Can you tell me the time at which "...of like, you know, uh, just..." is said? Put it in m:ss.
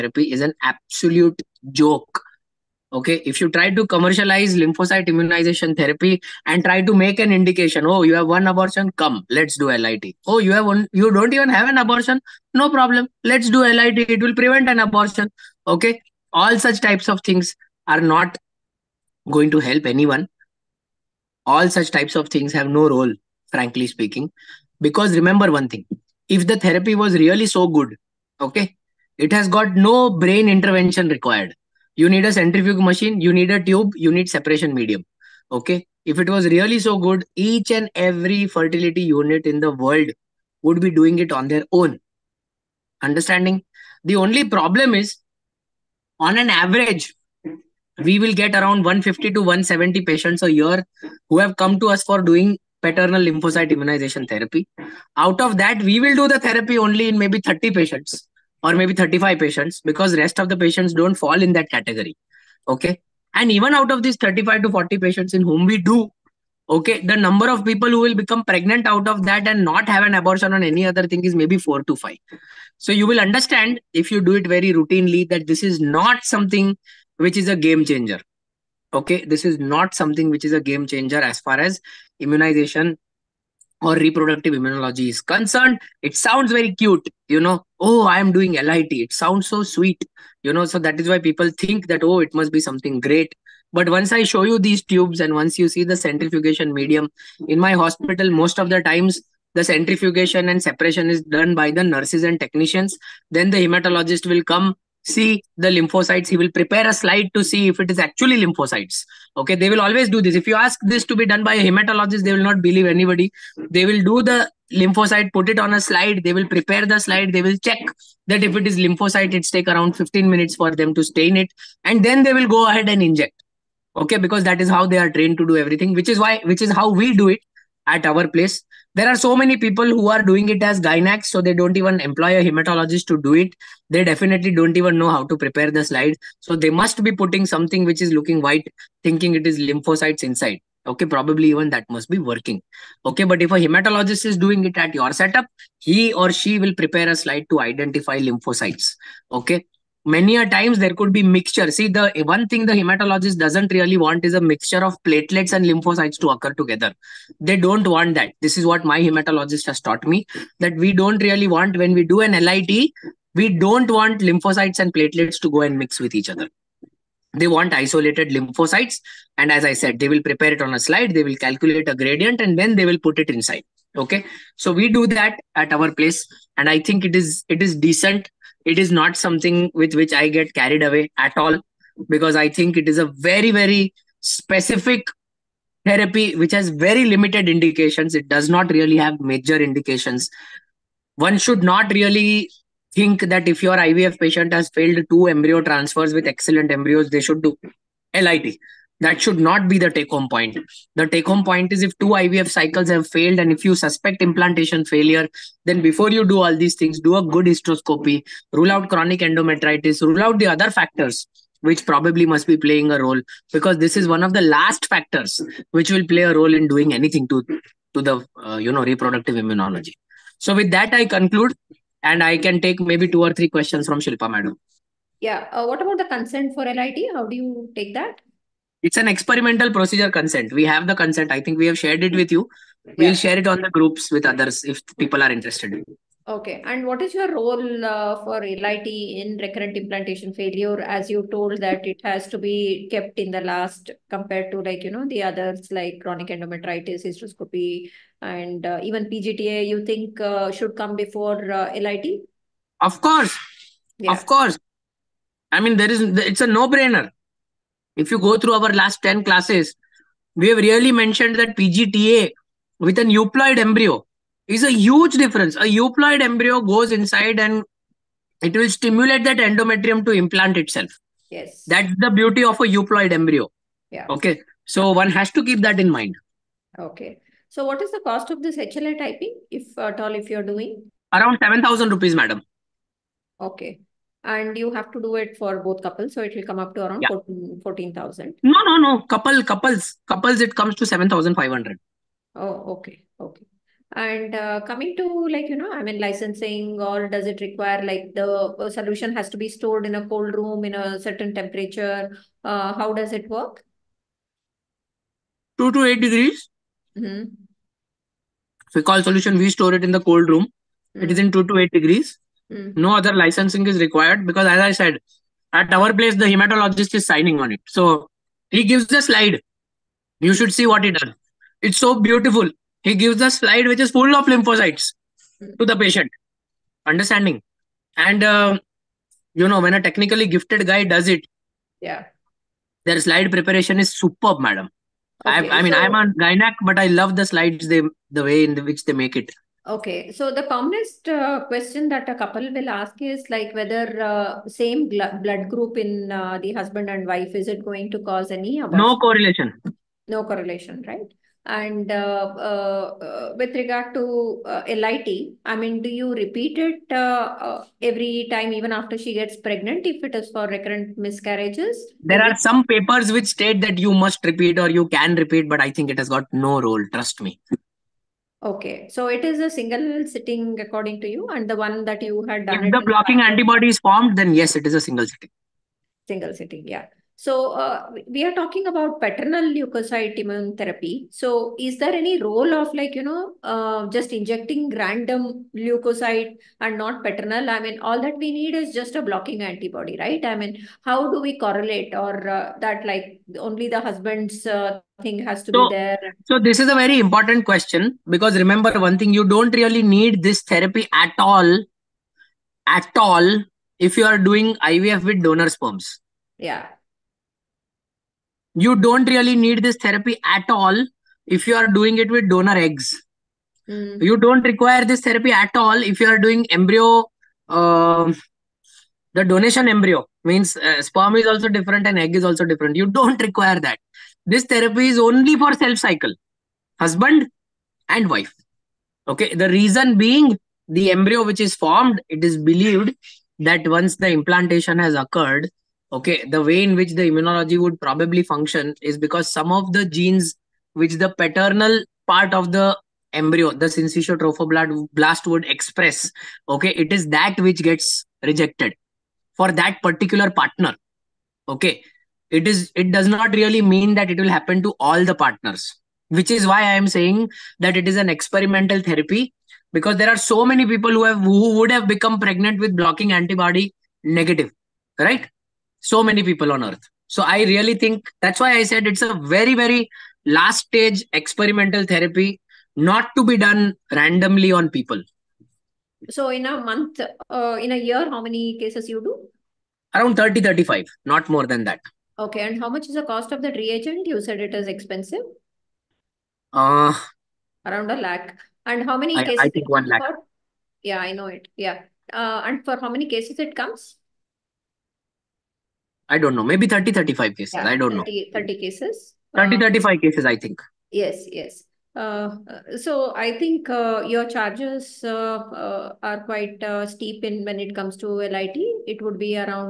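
6:22.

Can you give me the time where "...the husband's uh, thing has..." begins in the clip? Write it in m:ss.
6:33.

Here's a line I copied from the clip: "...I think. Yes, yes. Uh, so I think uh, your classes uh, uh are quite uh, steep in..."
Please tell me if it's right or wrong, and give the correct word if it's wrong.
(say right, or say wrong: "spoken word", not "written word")
wrong: "charges", not "classes".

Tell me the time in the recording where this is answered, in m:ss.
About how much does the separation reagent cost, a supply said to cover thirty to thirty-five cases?
8:07.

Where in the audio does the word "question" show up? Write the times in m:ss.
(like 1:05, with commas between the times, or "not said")
3:43, 5:41, 6:37.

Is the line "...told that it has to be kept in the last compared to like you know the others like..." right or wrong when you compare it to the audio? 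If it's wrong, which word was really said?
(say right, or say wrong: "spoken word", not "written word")
right.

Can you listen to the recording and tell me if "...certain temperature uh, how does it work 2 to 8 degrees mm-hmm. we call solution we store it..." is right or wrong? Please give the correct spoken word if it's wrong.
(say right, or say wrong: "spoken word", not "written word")
right.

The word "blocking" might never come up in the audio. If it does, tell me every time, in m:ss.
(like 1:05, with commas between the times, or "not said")
6:12, 6:29, 7:42.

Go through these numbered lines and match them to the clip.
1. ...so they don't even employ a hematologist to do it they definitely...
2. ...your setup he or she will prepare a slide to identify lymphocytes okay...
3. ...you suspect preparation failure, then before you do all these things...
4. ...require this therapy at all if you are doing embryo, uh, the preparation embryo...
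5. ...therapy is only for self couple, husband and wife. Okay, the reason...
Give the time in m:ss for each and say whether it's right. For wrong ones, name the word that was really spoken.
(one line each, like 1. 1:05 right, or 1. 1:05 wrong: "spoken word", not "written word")
1. 2:11 right
2. 2:24 right
3. 3:23 wrong: "implantation", not "preparation"
4. 6:54 wrong: "donation", not "preparation"
5. 7:04 wrong: "cycle", not "couple".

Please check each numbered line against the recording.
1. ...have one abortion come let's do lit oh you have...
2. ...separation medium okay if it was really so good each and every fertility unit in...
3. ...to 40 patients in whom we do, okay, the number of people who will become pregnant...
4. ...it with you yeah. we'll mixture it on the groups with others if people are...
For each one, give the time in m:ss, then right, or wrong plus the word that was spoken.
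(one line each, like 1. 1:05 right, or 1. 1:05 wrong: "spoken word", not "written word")
1. 0:08 right
2. 0:34 right
3. 1:04 right
4. 3:52 wrong: "share", not "mixture".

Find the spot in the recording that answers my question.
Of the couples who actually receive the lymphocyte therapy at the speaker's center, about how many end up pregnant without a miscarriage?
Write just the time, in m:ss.
1:11.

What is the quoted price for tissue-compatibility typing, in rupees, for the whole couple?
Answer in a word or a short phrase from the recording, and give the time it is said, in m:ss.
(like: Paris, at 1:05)
7,500 rupees, at 4:50.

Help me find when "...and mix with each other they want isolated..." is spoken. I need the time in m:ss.
2:45.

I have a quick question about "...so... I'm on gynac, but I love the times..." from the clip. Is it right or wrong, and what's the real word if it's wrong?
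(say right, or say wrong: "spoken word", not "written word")
wrong: "slides", not "times".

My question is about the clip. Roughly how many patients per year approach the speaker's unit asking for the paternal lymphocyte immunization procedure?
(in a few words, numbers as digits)
150 to 170.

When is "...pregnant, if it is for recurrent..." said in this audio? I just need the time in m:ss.
5:59.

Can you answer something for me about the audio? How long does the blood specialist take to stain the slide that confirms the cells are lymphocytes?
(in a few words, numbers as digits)
15 minutes.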